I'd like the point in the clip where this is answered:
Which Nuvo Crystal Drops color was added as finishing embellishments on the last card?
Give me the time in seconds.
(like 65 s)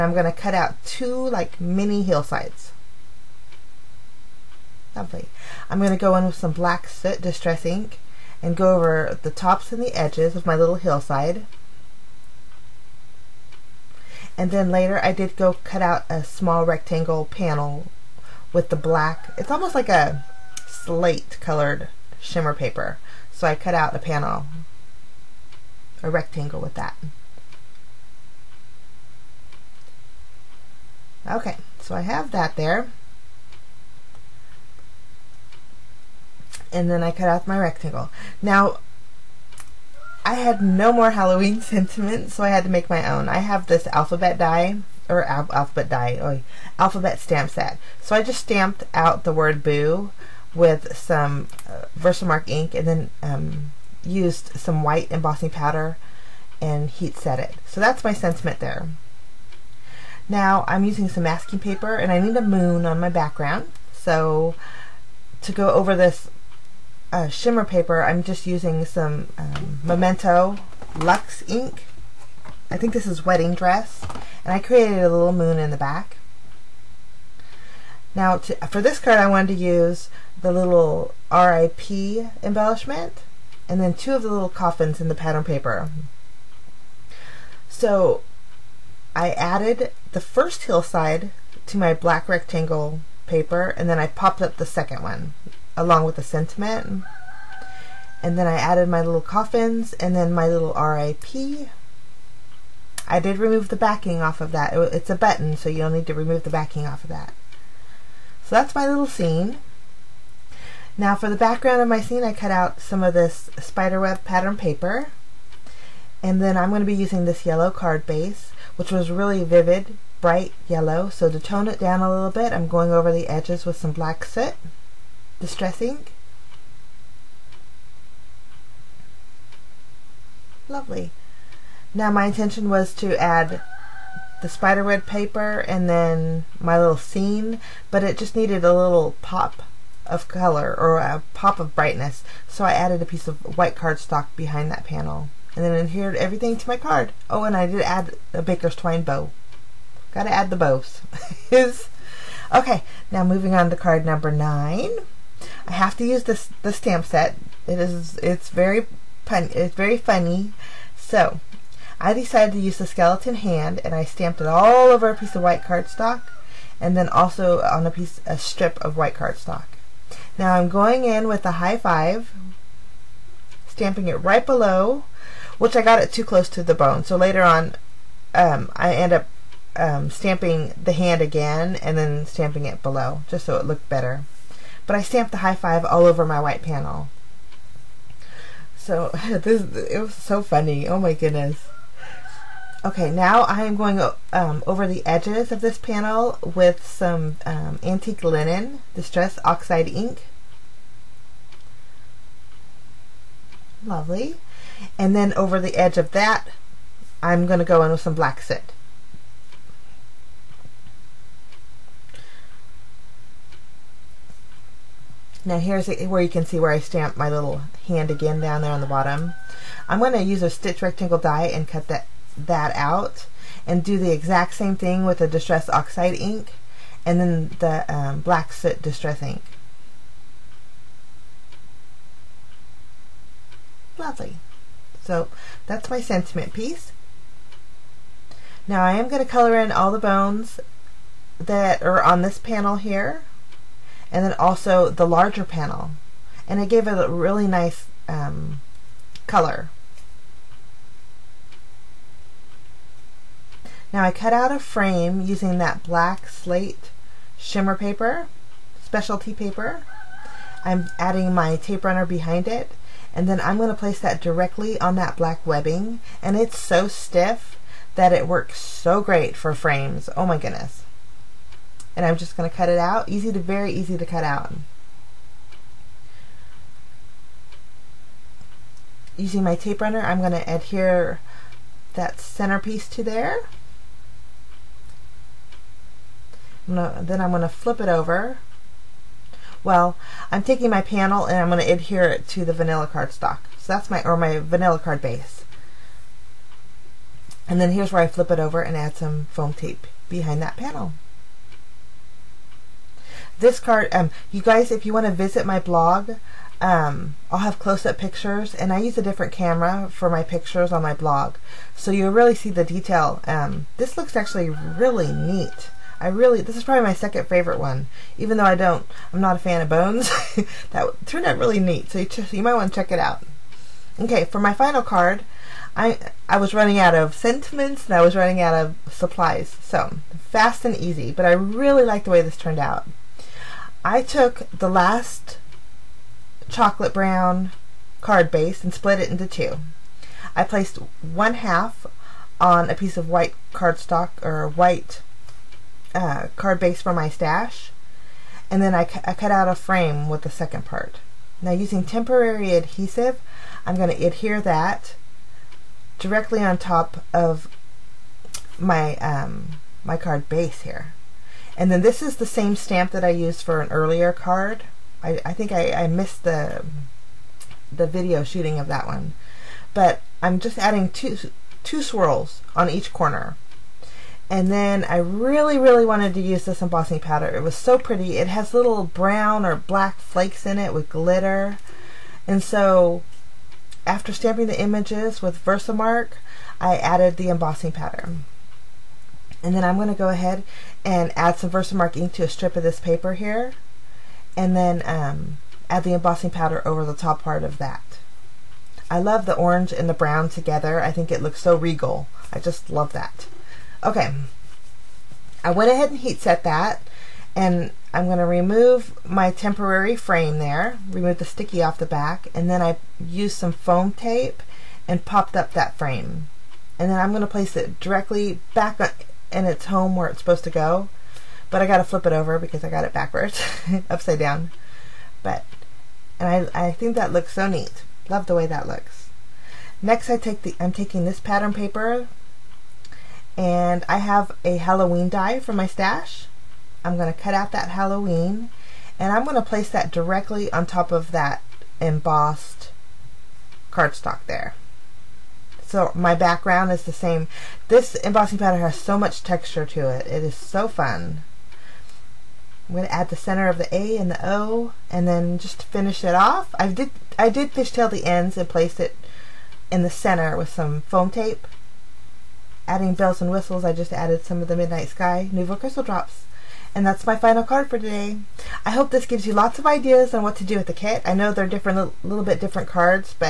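464 s.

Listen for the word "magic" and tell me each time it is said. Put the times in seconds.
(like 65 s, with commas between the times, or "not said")
not said.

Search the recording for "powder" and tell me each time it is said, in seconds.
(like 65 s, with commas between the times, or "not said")
55 s, 376 s, 387 s, 396 s.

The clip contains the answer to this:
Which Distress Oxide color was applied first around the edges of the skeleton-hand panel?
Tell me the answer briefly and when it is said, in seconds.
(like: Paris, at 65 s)
antique linen, at 197 s.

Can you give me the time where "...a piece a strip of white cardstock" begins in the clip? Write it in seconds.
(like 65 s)
167 s.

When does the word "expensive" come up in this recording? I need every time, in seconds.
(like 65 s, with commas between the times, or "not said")
not said.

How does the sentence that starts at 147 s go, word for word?
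Oh, and I did add a baker's twine bow.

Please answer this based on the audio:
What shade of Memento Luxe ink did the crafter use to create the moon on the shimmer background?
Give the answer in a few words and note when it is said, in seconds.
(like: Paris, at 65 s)
Wedding Dress, at 73 s.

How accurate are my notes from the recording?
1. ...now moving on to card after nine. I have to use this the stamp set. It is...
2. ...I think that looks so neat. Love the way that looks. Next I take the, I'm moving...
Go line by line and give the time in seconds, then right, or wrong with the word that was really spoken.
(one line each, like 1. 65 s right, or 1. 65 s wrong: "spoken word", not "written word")
1. 153 s wrong: "number", not "after"
2. 426 s wrong: "taking", not "moving".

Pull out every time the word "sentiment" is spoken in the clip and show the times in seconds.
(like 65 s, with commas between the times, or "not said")
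41 s, 58 s, 96 s, 236 s, 327 s.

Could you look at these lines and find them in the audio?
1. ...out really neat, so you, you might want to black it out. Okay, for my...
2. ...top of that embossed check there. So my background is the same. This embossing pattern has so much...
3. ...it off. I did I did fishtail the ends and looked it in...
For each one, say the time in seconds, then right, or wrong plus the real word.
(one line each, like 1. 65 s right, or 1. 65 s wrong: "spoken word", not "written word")
1. 321 s wrong: "check", not "black"
2. 440 s wrong: "cardstock", not "check"
3. 456 s wrong: "placed", not "looked".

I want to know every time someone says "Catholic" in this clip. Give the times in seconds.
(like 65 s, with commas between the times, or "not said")
not said.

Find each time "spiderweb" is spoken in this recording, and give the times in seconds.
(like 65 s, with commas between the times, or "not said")
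113 s, 134 s.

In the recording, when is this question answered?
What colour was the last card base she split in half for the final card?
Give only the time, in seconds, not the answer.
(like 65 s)
336 s.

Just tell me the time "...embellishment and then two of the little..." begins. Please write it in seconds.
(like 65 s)
82 s.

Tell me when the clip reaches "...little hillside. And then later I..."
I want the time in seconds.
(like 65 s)
10 s.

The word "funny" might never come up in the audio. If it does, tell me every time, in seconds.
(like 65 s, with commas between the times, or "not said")
159 s, 190 s.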